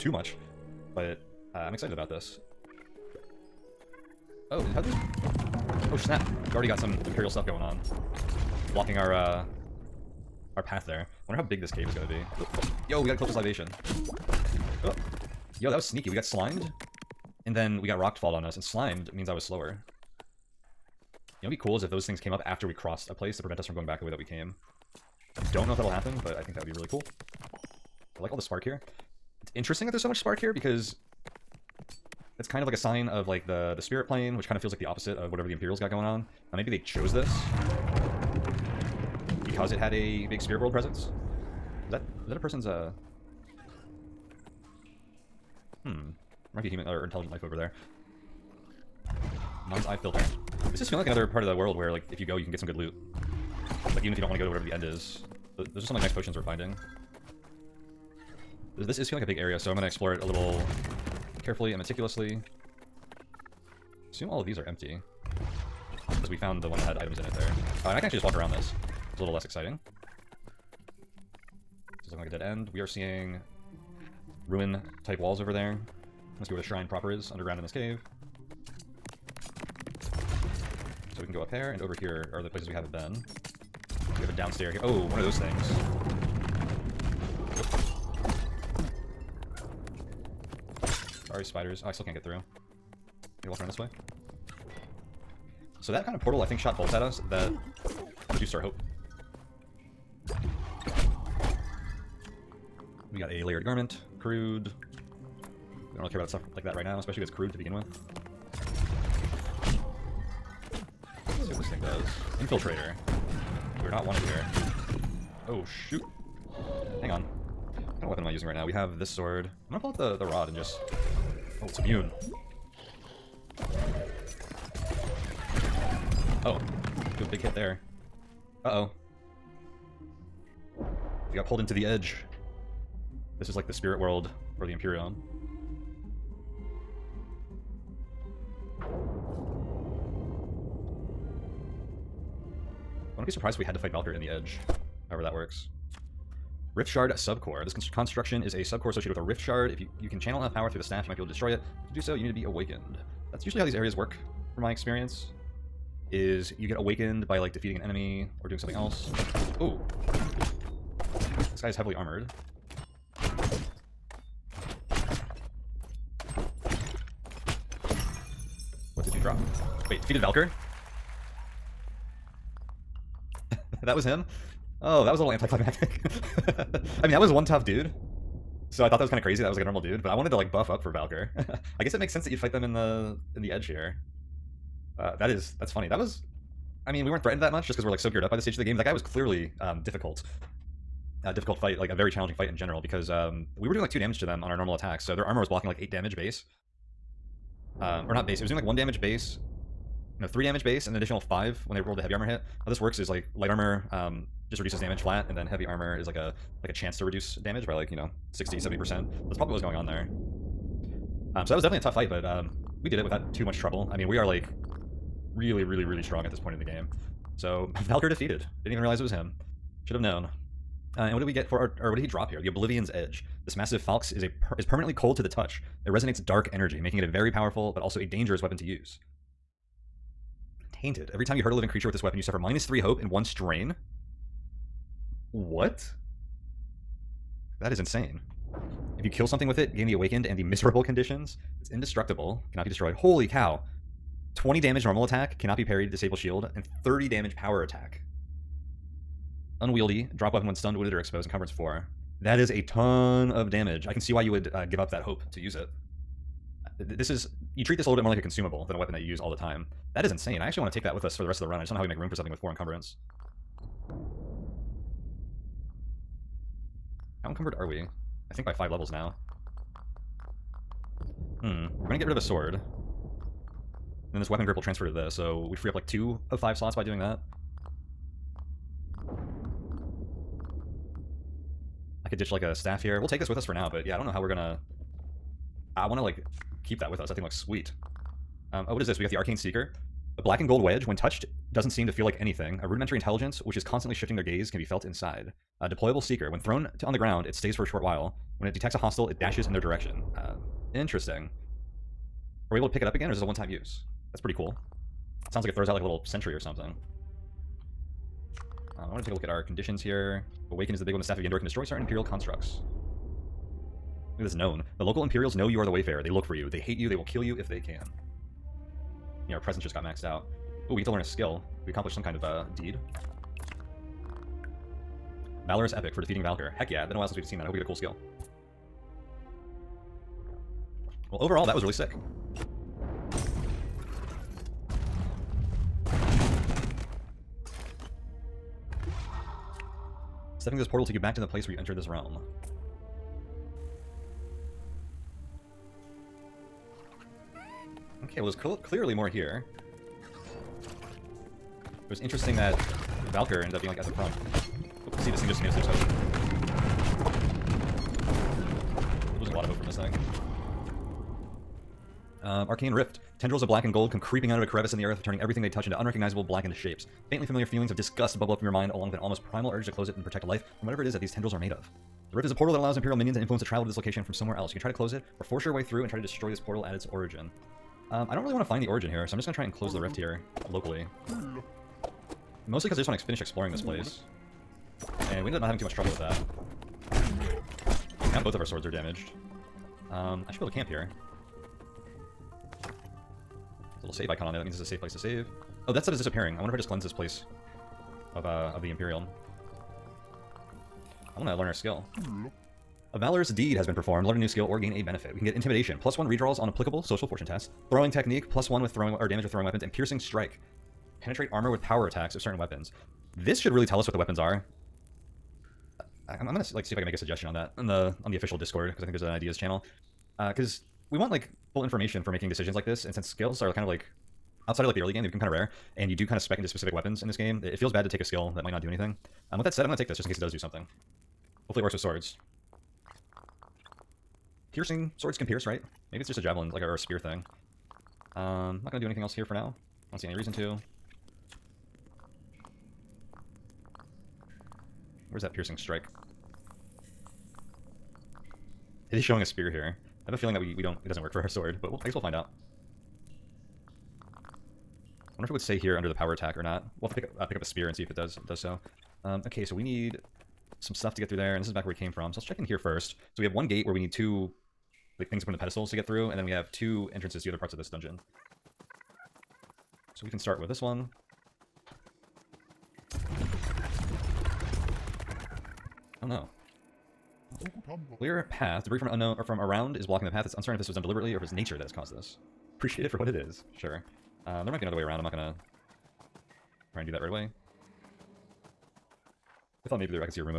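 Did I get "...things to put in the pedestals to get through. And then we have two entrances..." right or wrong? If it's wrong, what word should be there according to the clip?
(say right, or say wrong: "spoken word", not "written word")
right.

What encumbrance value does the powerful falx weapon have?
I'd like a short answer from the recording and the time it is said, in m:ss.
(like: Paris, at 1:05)
4, at 4:11.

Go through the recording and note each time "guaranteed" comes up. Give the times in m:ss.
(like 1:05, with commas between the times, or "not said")
not said.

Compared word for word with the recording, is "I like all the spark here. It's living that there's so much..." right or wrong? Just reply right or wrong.
wrong.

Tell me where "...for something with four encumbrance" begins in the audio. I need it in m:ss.
4:22.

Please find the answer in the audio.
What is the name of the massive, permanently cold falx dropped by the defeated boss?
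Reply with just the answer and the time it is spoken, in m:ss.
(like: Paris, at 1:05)
The Oblivion's Edge, at 3:42.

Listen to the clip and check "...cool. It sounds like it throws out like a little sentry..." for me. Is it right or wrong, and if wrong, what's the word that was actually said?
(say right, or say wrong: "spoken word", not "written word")
right.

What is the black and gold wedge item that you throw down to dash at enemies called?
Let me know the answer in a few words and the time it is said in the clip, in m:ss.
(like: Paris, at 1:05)
Arcane Seeker, at 4:49.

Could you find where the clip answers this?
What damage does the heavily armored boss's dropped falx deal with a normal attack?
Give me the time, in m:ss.
4:04.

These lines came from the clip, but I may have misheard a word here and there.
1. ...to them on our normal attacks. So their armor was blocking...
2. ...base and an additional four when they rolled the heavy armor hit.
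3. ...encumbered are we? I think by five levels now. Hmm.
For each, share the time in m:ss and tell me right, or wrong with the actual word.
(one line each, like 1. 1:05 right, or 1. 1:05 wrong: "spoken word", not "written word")
1. 3:14 right
2. 3:20 wrong: "five", not "four"
3. 4:27 right.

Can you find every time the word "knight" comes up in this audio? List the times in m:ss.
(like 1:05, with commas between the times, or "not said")
not said.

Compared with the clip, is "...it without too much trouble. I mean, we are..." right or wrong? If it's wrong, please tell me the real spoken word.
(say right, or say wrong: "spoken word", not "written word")
right.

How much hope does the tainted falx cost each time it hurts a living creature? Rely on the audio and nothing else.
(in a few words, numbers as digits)
3.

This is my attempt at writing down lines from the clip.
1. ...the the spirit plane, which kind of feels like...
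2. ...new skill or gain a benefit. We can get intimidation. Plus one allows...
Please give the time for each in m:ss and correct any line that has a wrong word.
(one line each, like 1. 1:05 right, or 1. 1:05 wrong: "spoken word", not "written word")
1. 0:33 right
2. 6:44 wrong: "redraws", not "allows".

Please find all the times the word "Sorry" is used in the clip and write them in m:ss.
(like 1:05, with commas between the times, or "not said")
1:31.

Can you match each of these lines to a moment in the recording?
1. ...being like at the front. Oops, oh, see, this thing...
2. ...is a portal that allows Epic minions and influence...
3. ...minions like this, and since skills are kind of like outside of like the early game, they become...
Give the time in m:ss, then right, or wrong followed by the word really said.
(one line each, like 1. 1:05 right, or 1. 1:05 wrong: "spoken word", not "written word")
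1. 5:53 right
2. 6:12 wrong: "Imperial", not "Epic"
3. 7:02 wrong: "decisions", not "minions".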